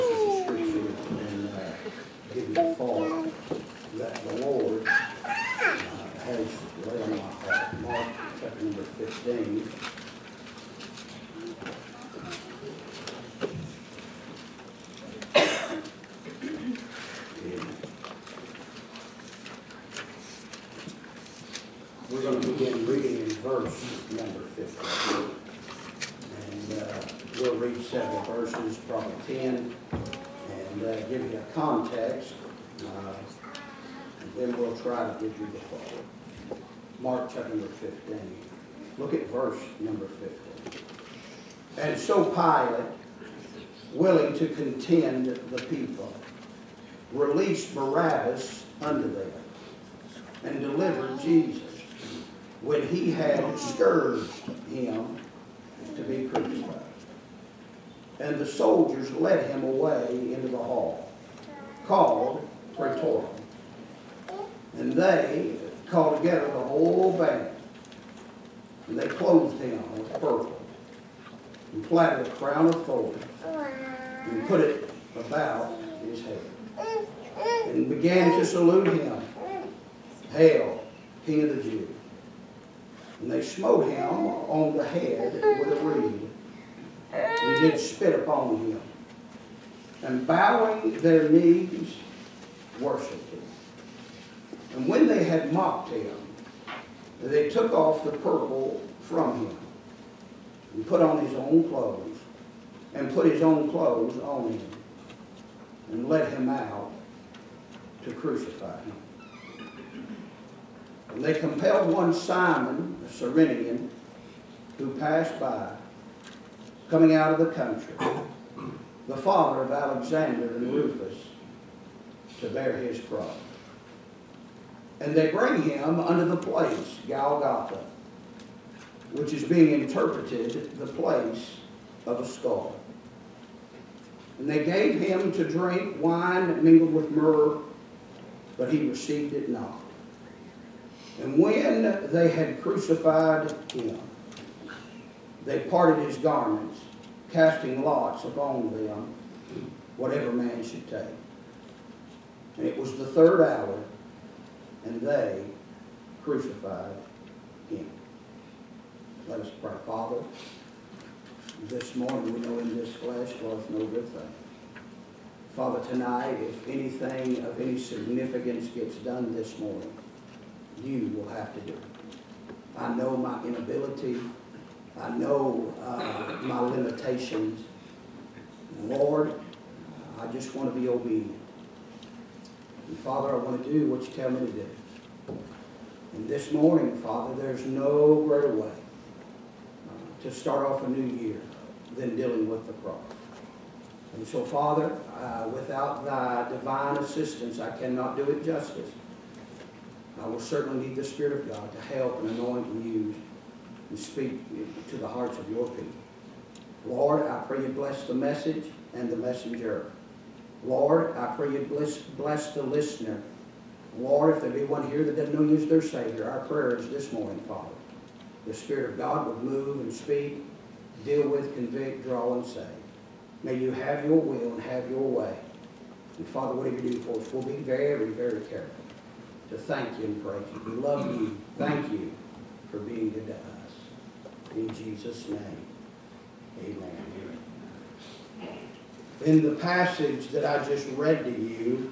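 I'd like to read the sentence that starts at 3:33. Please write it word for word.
Lord, if there be one here that doesn't know you as their Savior, our prayer is this morning, Father.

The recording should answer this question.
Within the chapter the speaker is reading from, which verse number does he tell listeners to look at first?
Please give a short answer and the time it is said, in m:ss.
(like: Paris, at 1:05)
15, at 0:39.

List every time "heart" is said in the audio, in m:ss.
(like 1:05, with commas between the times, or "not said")
0:07, 3:25.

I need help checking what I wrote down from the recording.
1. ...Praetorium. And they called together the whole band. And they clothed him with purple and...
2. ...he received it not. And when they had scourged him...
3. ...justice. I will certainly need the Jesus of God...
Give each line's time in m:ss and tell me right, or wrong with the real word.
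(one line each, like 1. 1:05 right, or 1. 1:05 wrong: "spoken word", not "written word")
1. 1:02 right
2. 2:18 wrong: "crucified", not "scourged"
3. 3:18 wrong: "Spirit", not "Jesus".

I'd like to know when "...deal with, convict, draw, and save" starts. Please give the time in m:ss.
3:41.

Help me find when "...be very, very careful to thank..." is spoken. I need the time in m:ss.
3:47.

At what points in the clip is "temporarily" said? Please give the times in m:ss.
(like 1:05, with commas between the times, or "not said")
not said.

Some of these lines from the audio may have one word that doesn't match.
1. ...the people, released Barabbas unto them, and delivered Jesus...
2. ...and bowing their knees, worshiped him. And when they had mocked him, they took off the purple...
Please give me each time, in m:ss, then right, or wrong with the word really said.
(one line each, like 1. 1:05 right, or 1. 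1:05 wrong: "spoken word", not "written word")
1. 0:45 right
2. 1:30 right.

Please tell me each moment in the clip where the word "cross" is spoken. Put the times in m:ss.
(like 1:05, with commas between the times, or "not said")
2:03, 3:12.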